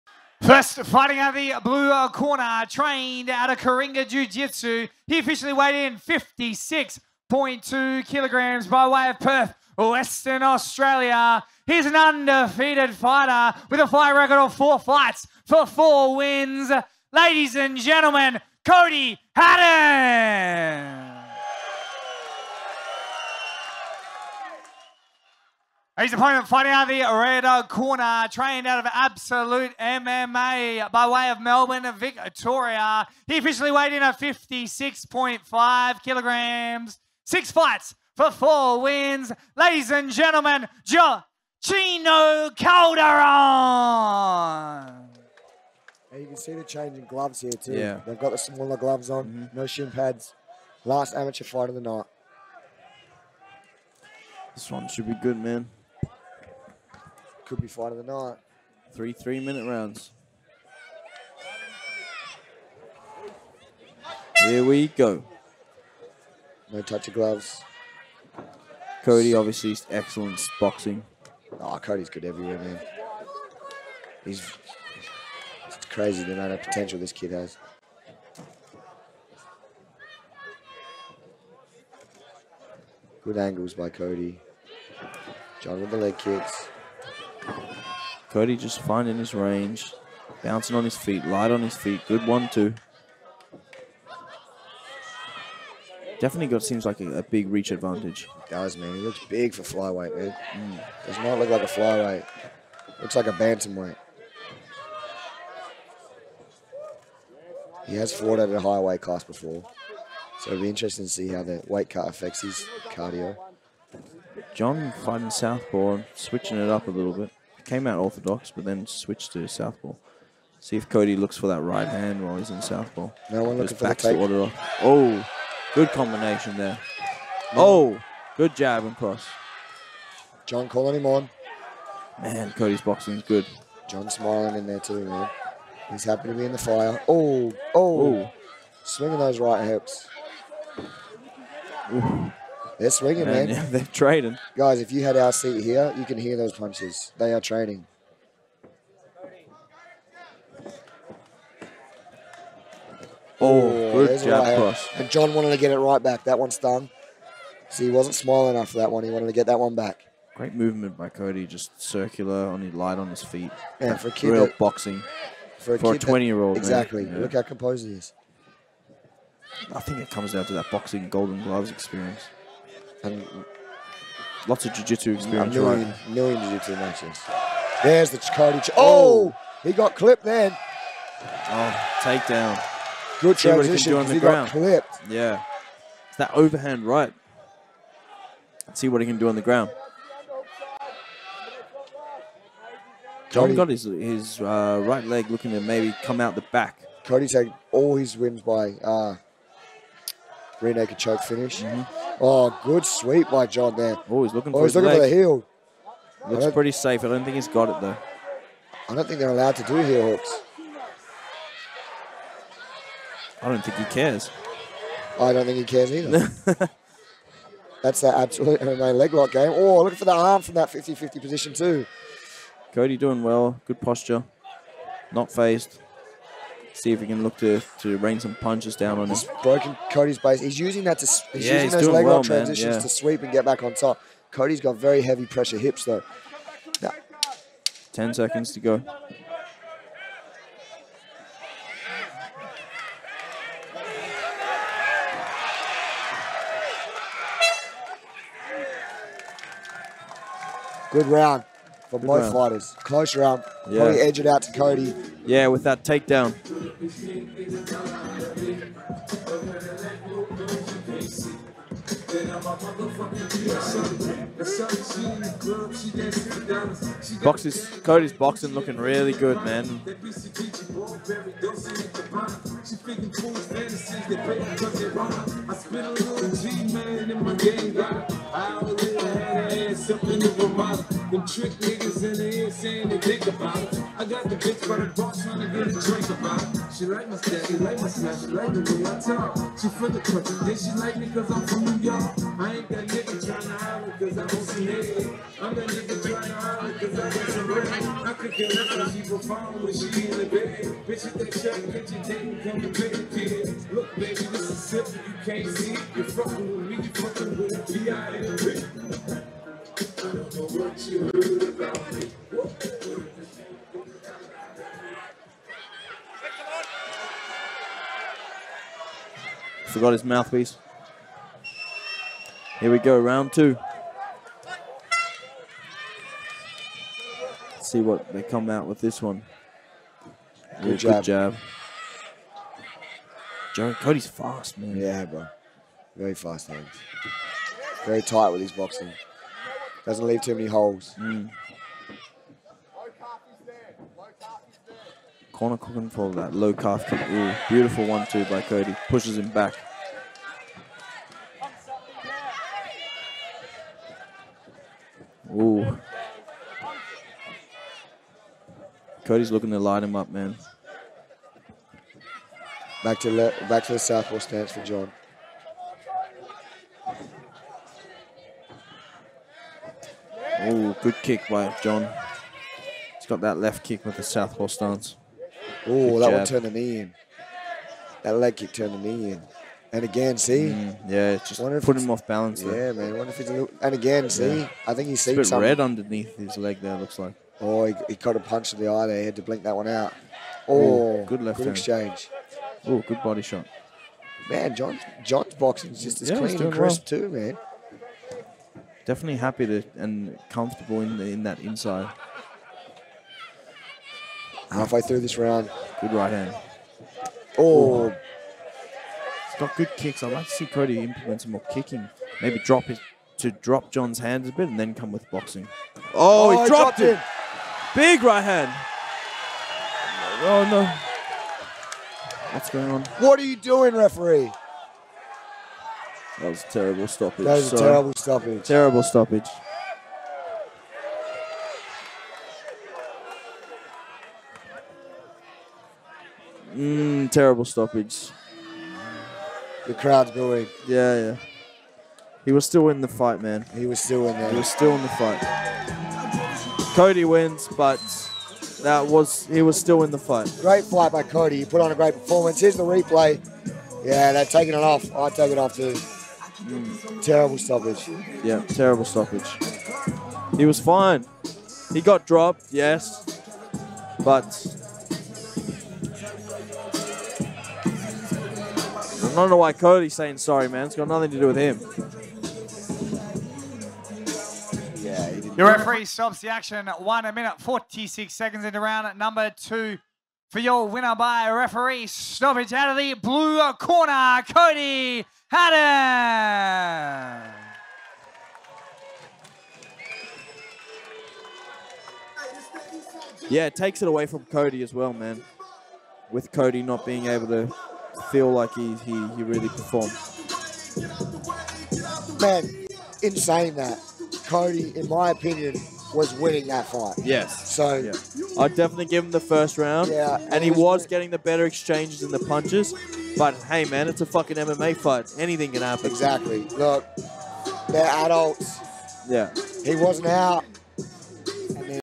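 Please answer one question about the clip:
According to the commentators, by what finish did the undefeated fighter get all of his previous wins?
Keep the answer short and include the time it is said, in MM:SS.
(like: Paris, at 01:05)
rear naked choke, at 03:20.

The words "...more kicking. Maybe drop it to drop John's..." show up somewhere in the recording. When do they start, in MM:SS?
06:51.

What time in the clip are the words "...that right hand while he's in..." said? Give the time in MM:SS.
02:01.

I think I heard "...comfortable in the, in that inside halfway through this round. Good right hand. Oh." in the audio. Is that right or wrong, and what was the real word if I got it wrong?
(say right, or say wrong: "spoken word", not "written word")
right.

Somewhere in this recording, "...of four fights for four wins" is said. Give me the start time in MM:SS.
00:14.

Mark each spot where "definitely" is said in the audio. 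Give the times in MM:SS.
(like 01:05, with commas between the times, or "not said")
01:36, 06:38, 08:28.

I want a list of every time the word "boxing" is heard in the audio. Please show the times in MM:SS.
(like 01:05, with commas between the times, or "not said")
01:10, 02:12, 02:44, 02:50, 05:38, 06:55.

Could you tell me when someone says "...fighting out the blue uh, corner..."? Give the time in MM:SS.
00:00.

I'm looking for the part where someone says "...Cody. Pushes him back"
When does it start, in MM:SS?
05:48.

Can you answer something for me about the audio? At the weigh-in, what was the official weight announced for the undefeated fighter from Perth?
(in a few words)
56.2 kilograms.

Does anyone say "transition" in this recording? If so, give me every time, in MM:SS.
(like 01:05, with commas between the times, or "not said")
03:03, 03:52.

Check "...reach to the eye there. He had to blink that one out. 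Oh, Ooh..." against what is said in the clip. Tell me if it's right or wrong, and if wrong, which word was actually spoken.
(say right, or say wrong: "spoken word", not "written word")
wrong: "punch", not "reach".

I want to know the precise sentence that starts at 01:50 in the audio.
So it'll be interesting to see how the weight cut affects his cardio.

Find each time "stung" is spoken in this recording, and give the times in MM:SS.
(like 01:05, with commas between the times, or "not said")
02:36.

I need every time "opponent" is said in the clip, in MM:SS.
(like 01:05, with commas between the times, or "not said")
00:26.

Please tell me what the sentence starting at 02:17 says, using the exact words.
Oh, oh, swinging those right hips.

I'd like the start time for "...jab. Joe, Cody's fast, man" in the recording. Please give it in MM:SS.
05:31.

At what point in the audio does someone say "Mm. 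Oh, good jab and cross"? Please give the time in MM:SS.
02:06.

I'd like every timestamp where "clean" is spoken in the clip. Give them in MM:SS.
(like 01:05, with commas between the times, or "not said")
06:36.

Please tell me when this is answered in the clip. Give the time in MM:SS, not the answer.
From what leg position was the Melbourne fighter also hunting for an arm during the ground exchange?
03:40.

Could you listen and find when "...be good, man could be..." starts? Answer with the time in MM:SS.
00:55.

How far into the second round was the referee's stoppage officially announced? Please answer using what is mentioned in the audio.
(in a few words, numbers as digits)
1 minute 46 seconds.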